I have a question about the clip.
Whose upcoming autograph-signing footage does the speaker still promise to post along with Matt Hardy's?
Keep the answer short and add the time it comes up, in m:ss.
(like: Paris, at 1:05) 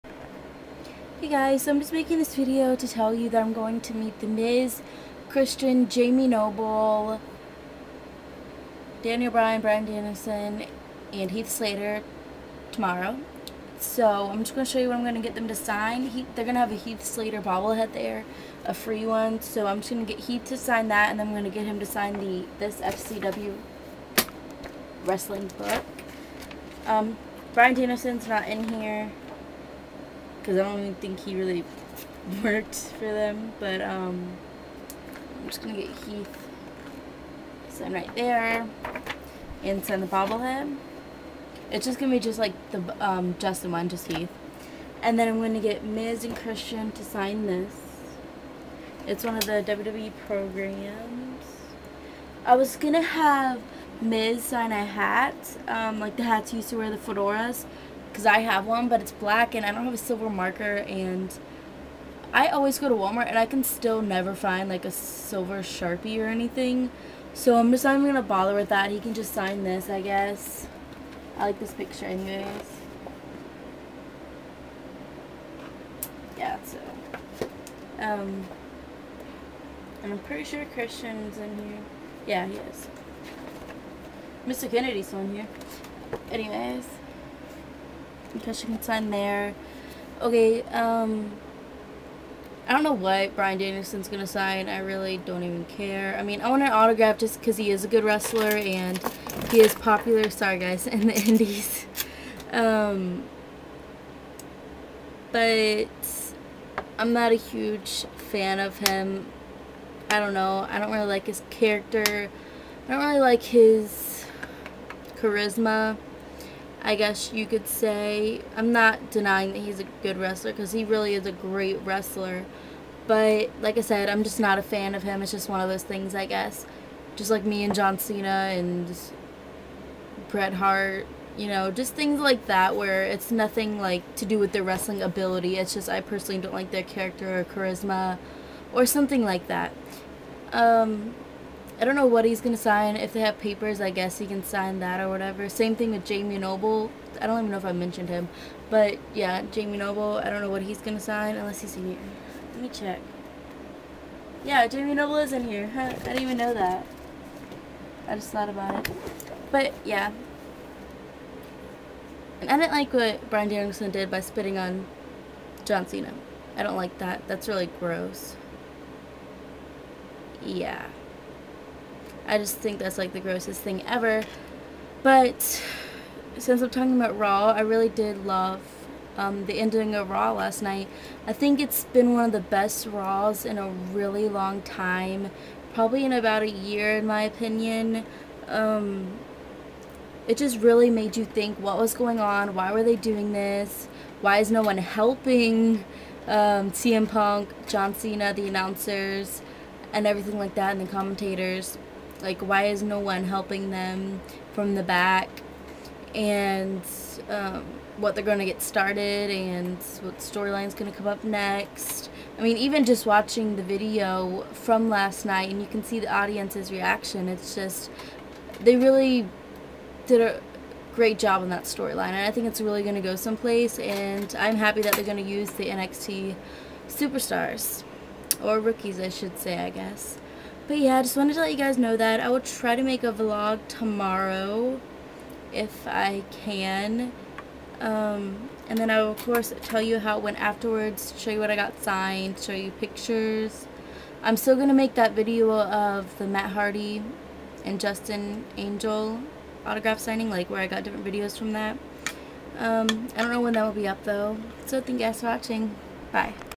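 Justin Angel, at 4:07.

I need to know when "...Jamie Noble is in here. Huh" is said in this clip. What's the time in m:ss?
2:34.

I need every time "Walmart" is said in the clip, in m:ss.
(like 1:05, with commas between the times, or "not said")
1:02.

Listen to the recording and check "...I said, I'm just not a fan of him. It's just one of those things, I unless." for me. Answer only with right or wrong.
wrong.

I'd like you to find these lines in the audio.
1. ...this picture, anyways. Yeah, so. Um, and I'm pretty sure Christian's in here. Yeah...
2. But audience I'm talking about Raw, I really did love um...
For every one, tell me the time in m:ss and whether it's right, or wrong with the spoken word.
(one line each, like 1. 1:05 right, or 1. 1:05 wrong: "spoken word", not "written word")
1. 1:11 right
2. 2:55 wrong: "since", not "audience".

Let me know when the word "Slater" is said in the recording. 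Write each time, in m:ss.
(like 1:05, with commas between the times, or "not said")
0:11, 0:17.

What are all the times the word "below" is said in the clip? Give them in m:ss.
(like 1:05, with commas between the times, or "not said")
not said.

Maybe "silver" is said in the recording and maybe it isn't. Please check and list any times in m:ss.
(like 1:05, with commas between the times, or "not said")
0:59, 1:04.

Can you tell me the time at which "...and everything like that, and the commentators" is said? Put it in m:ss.
3:19.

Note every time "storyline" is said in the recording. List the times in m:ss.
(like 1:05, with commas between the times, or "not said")
3:30, 3:41.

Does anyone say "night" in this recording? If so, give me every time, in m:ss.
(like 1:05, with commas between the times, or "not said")
3:00, 3:35.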